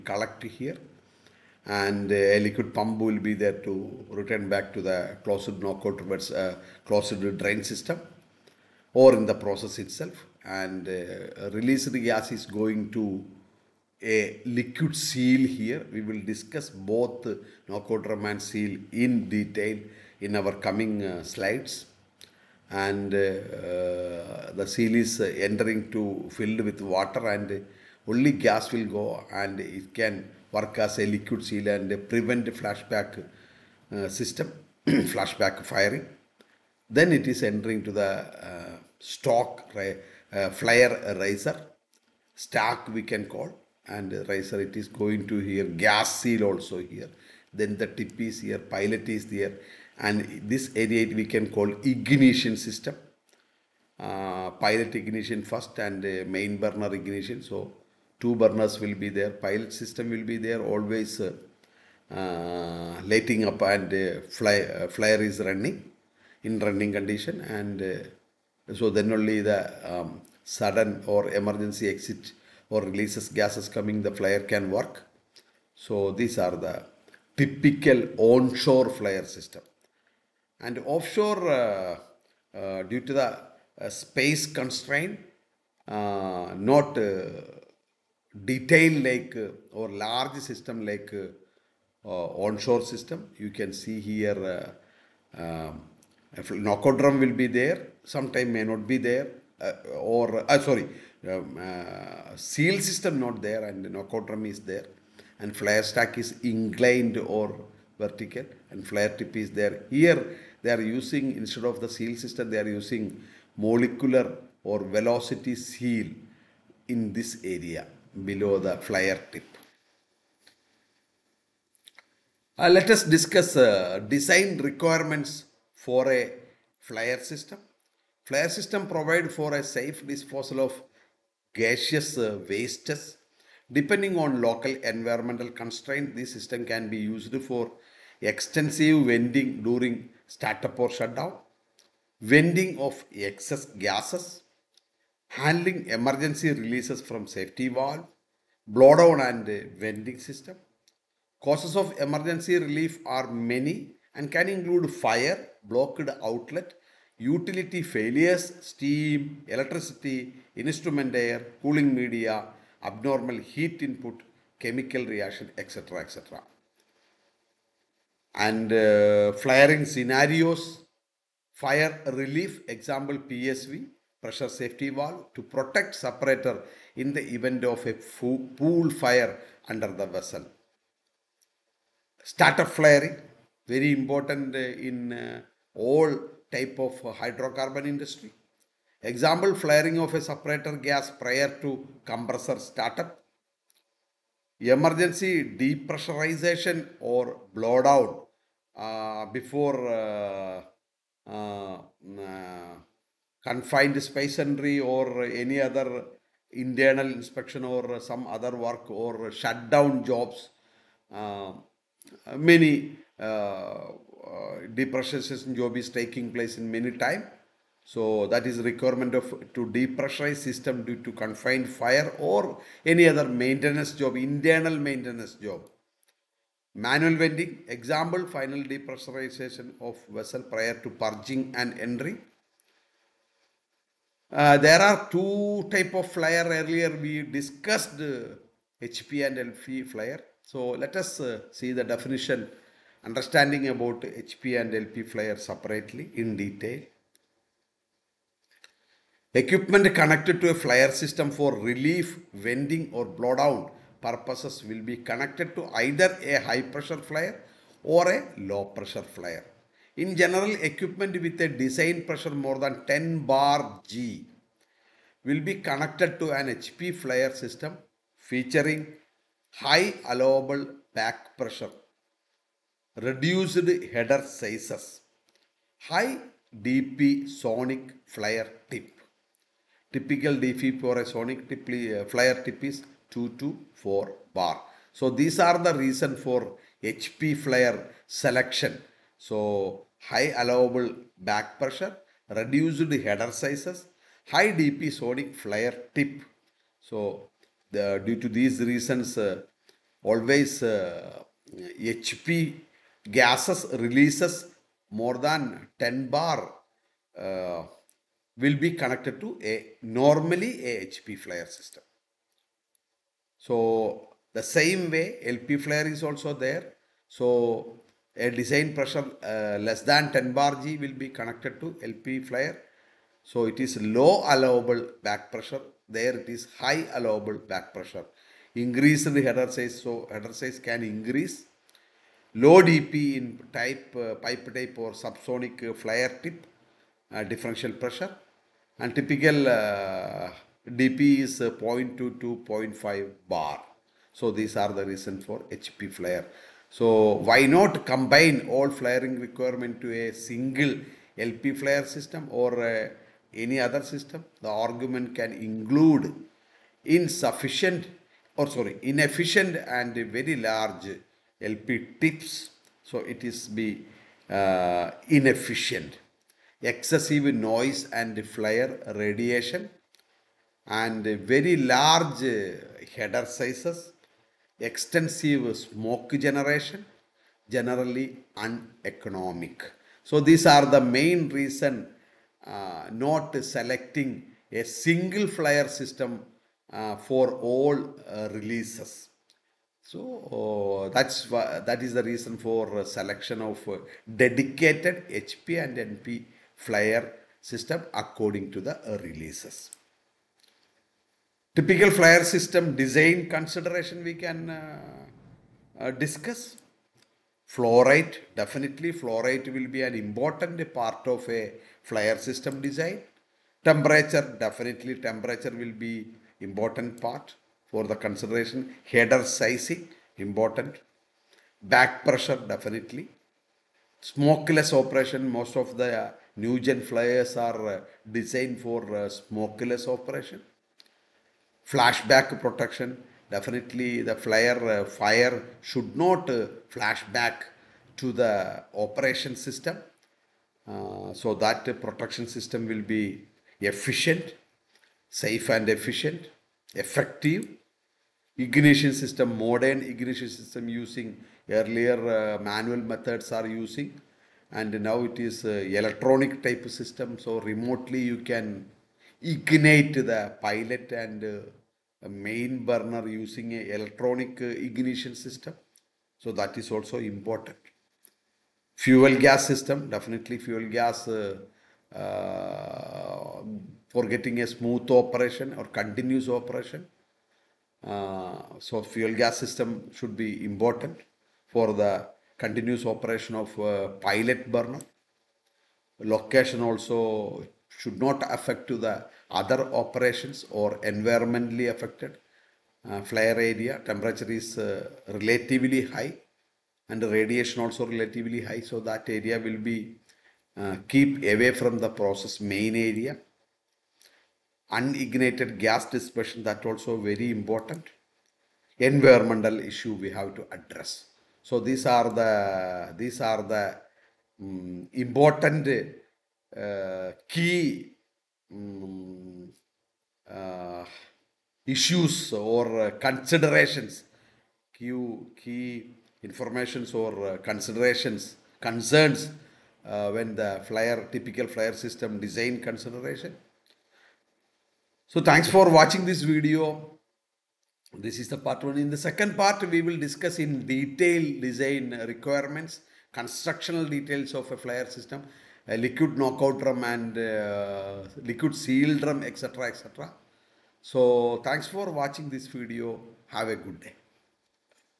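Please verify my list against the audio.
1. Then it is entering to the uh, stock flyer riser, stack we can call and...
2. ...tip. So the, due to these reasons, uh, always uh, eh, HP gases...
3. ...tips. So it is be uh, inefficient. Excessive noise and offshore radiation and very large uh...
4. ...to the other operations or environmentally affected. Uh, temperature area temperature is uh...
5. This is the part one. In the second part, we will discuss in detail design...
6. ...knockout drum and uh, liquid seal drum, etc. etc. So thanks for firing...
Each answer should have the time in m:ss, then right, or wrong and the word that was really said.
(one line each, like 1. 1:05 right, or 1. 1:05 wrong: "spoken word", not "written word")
1. 0:36 right
2. 4:55 right
3. 6:02 wrong: "flare", not "offshore"
4. 8:08 wrong: "flare", not "temperature"
5. 8:58 right
6. 9:06 wrong: "watching", not "firing".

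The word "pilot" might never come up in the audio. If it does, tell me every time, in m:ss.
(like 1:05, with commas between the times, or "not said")
0:48, 0:54, 0:59, 7:40, 8:04.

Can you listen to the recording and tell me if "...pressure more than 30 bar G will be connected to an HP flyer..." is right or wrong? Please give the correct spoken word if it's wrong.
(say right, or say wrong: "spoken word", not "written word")
wrong: "10", not "30".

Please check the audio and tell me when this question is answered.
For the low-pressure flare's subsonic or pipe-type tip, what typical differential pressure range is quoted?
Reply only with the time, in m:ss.
5:41.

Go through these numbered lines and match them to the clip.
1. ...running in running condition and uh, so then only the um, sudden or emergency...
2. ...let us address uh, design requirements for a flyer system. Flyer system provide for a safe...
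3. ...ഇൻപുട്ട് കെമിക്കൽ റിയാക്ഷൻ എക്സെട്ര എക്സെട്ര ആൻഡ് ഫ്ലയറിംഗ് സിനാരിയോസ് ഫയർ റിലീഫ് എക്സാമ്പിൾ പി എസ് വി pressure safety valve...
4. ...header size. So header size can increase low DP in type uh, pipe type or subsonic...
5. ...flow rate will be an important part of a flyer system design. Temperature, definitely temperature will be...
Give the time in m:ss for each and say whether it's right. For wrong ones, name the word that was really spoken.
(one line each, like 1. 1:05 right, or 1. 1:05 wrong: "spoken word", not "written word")
1. 1:05 right
2. 2:02 wrong: "discuss", not "address"
3. 2:43 right
4. 5:29 right
5. 6:48 right.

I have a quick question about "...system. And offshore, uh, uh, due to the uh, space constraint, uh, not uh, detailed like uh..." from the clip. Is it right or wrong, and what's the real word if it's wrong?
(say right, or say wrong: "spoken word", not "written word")
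right.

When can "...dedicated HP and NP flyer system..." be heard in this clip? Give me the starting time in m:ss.
6:34.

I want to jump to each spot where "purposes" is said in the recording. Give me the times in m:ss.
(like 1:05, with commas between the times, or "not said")
4:14.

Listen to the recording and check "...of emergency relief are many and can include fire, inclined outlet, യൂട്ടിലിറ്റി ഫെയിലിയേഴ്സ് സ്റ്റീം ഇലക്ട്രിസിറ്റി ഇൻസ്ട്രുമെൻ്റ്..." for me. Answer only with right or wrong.
wrong.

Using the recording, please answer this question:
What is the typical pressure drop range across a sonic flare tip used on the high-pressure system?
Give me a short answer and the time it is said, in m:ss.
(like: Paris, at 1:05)
2 to 4 bar, at 4:43.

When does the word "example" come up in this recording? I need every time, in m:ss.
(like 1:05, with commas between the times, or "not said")
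3:09, 3:47.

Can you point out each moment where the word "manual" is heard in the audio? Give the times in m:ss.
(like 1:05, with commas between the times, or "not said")
3:46, 7:32.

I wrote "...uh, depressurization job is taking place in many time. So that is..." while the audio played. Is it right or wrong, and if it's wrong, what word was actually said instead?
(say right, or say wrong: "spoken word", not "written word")
right.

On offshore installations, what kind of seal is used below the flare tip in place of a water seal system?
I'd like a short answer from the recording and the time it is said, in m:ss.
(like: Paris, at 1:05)
Molecular or velocity seal, at 1:53.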